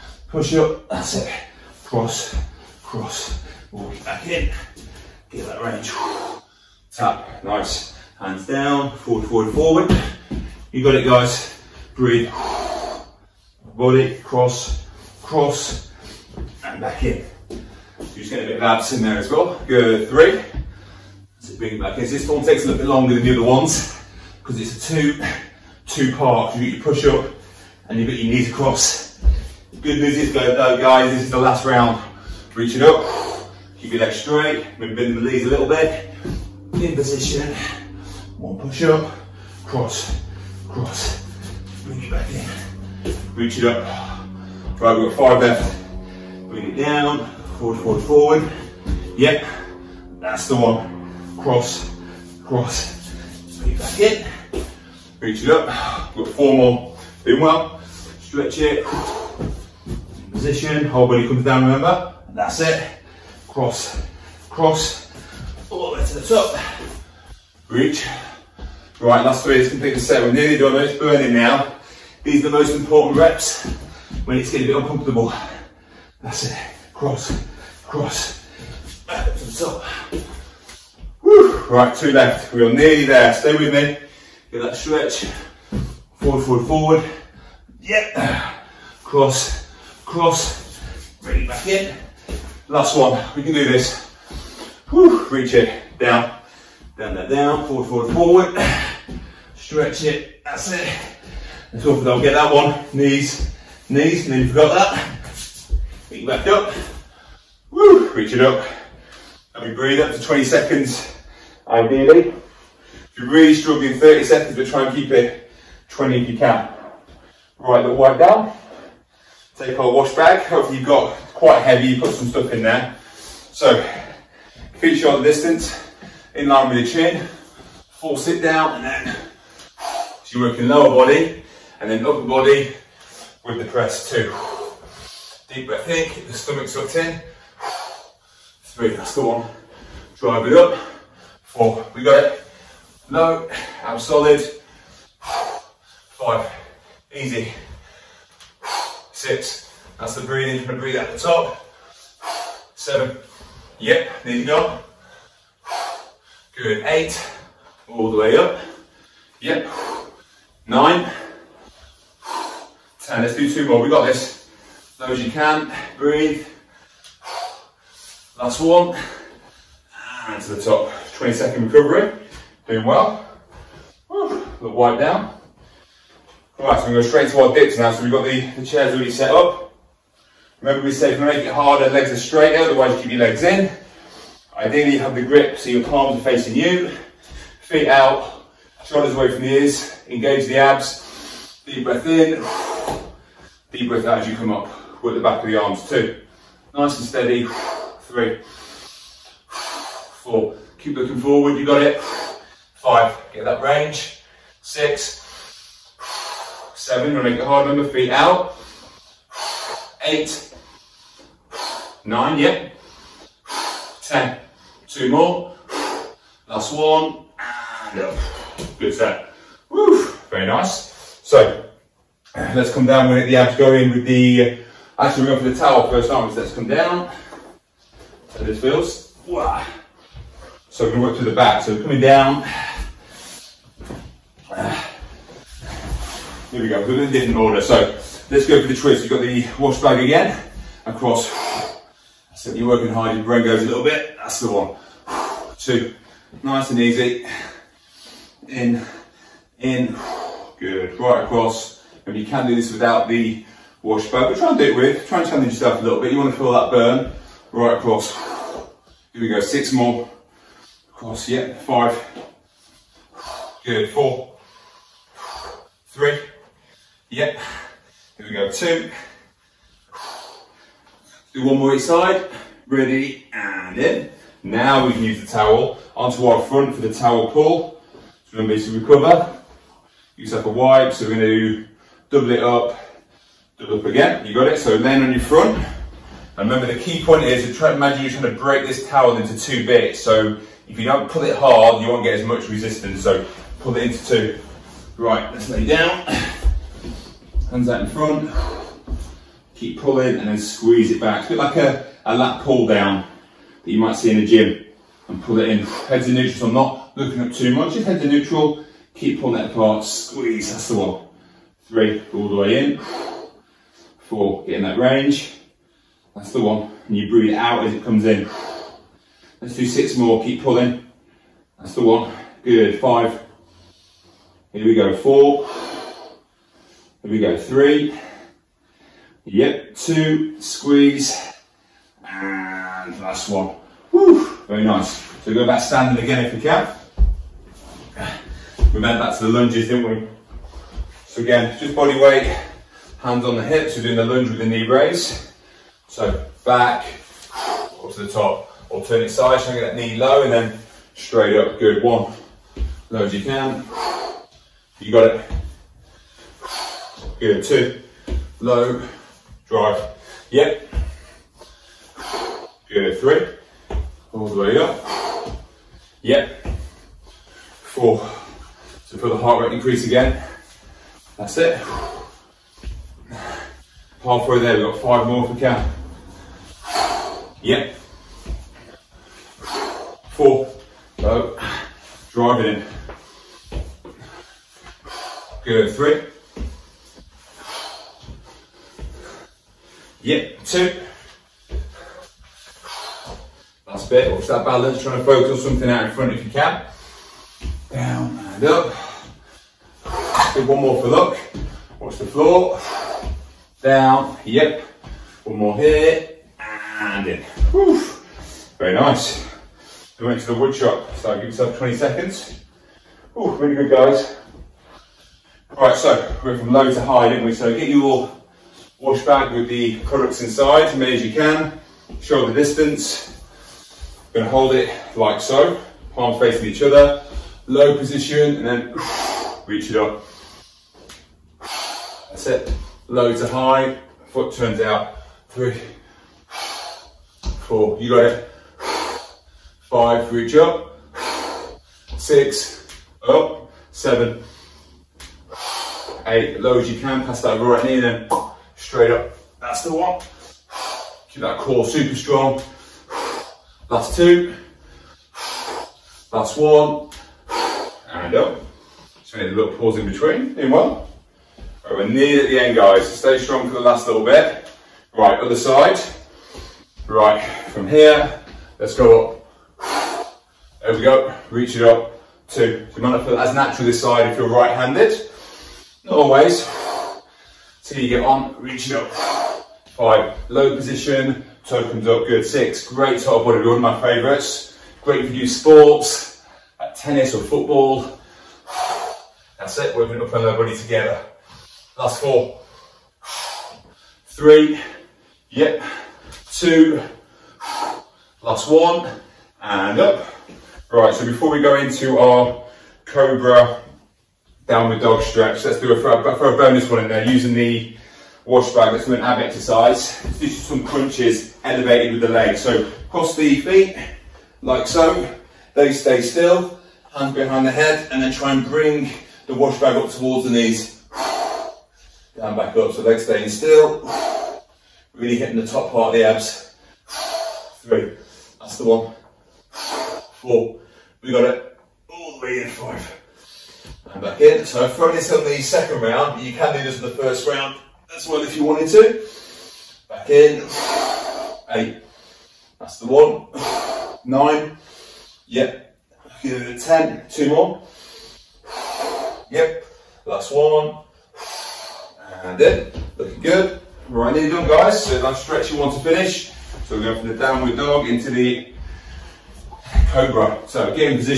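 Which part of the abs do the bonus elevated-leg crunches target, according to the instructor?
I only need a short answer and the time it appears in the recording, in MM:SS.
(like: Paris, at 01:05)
Top part, at 08:45.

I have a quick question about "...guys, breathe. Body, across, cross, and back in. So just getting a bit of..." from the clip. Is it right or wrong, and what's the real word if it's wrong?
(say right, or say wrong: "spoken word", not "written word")
wrong: "cross", not "across".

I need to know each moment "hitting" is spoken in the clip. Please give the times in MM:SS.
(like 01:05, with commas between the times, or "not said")
08:45.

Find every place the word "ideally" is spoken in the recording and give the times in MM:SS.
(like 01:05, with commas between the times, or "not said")
01:51, 03:04.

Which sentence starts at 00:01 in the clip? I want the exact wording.
Cross, cross, walk it back in.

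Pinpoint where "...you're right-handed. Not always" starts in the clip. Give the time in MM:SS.
07:54.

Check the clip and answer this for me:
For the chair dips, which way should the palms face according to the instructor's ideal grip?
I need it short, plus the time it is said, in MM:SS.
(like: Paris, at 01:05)
Facing you, at 03:05.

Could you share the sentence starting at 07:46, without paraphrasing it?
Right, from here, let's go up.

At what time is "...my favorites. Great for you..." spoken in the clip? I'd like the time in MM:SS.
08:03.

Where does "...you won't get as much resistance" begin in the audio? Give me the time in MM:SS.
04:51.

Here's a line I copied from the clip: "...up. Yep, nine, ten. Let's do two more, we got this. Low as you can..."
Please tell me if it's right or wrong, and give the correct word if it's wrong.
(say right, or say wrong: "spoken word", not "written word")
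right.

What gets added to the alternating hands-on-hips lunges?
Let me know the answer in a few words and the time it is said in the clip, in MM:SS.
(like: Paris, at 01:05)
Knee brace, at 05:44.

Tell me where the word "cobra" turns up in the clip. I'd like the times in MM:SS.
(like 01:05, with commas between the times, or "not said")
08:22, 09:19.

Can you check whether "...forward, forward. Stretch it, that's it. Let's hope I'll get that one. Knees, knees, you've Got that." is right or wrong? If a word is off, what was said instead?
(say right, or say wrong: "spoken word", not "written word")
right.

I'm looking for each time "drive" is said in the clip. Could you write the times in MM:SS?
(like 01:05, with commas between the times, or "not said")
02:20, 05:59, 06:22.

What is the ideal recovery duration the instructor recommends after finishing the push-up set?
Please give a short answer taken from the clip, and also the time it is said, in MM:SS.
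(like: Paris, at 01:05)
20 seconds, at 01:50.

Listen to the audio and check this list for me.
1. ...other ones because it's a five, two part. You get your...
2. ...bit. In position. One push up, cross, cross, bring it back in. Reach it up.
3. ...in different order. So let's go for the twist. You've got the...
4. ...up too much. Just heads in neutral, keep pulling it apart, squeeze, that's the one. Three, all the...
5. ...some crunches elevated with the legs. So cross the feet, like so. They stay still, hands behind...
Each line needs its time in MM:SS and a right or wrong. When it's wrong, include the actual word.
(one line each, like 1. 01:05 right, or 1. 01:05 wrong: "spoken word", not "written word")
1. 00:23 wrong: "two", not "five"
2. 00:35 right
3. 03:57 right
4. 05:07 right
5. 08:30 right.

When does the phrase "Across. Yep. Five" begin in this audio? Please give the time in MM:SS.
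04:20.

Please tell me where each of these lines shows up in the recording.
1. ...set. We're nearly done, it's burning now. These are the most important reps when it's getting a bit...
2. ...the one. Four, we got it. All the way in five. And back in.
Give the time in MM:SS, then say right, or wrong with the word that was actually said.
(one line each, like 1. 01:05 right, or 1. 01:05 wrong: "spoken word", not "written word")
1. 01:09 right
2. 08:48 right.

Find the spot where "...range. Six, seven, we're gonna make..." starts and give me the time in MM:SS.
03:23.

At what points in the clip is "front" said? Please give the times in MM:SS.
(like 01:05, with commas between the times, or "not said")
04:36, 04:45, 04:57, 06:35.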